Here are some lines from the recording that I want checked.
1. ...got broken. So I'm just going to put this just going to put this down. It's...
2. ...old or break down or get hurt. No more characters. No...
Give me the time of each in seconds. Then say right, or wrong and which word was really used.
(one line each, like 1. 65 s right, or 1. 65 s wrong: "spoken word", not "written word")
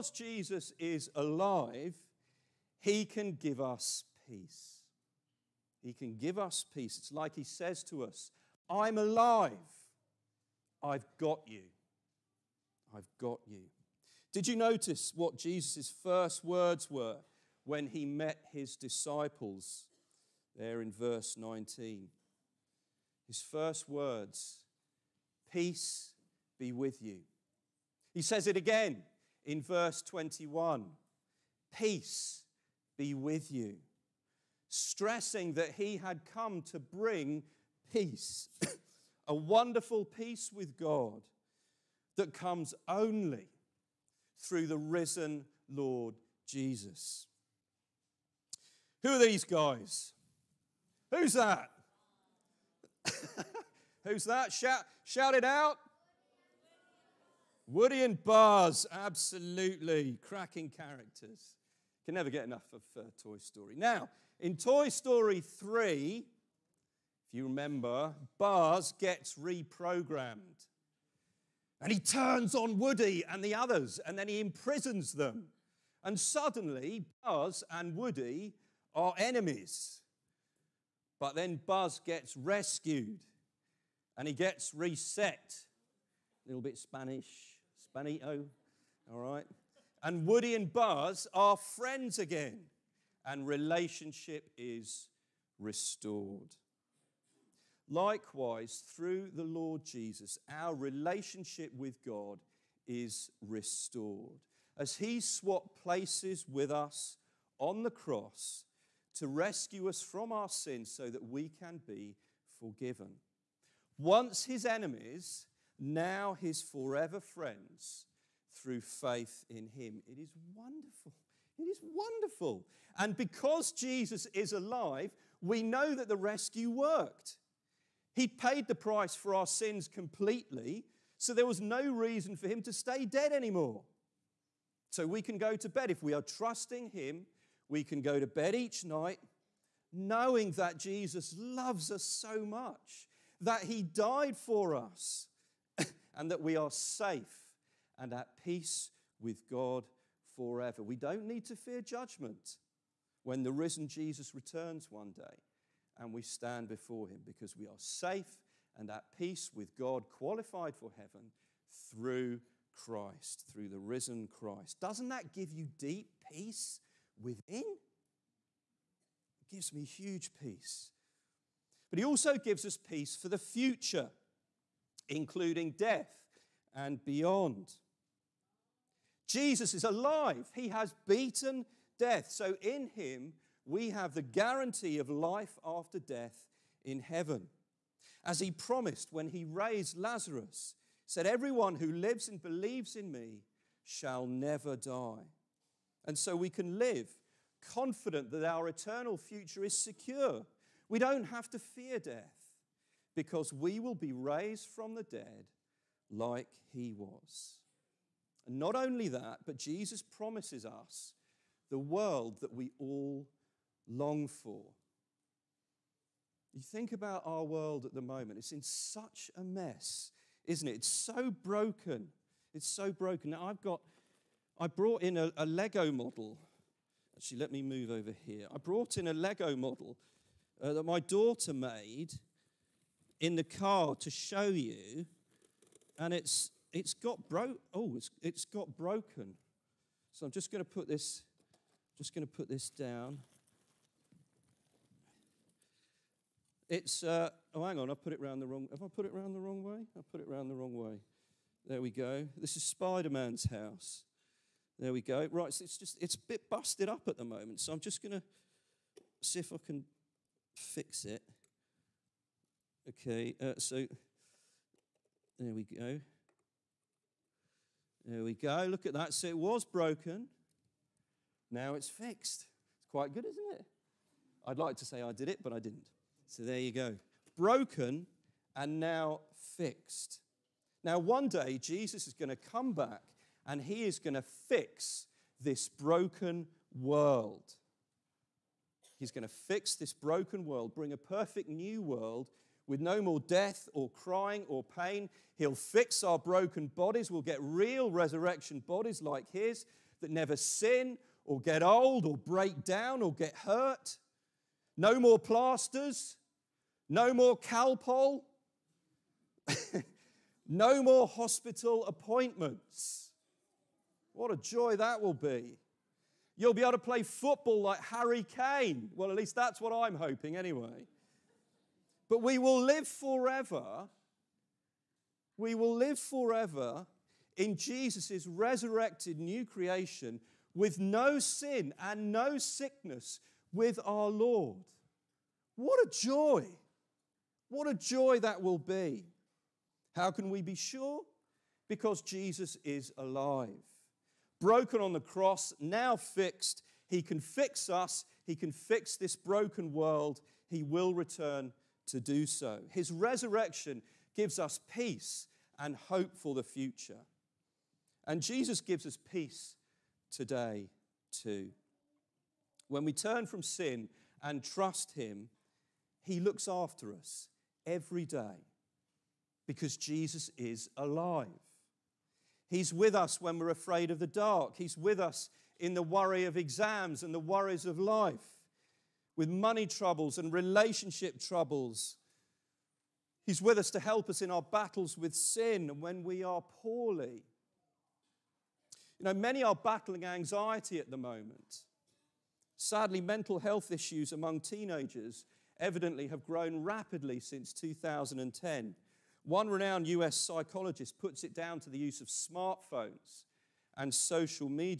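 1. 238 s right
2. 301 s wrong: "plasters", not "characters".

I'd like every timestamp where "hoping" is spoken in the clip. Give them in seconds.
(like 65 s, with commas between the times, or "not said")
319 s.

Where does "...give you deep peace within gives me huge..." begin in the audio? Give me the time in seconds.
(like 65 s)
165 s.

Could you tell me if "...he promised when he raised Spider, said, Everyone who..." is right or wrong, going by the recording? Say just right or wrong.
wrong.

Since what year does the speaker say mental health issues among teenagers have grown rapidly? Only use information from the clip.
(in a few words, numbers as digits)
2010.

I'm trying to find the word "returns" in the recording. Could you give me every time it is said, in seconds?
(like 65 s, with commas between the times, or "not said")
154 s, 350 s.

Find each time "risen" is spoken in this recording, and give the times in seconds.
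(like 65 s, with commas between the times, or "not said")
44 s, 153 s, 163 s.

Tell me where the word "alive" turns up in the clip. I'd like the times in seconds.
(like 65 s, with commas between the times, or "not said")
1 s, 8 s, 124 s, 179 s, 342 s, 370 s.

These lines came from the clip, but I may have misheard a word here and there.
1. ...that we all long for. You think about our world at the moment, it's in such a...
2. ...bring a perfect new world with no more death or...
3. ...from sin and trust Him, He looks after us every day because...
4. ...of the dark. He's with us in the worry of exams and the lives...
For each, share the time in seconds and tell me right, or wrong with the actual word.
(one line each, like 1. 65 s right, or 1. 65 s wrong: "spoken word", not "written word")
1. 212 s right
2. 290 s right
3. 363 s right
4. 373 s wrong: "worries", not "lives".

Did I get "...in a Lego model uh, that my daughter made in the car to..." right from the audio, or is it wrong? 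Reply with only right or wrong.
right.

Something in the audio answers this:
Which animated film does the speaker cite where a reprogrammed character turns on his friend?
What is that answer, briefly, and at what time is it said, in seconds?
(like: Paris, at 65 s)
Toy Story 3, at 64 s.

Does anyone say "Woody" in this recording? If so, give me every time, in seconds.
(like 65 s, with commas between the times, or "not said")
57 s, 72 s, 77 s, 90 s.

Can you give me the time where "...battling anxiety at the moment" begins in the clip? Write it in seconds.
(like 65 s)
389 s.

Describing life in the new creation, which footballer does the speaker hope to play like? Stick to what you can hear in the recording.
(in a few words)
Harry Kane.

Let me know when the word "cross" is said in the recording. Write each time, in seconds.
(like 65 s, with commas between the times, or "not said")
107 s, 345 s.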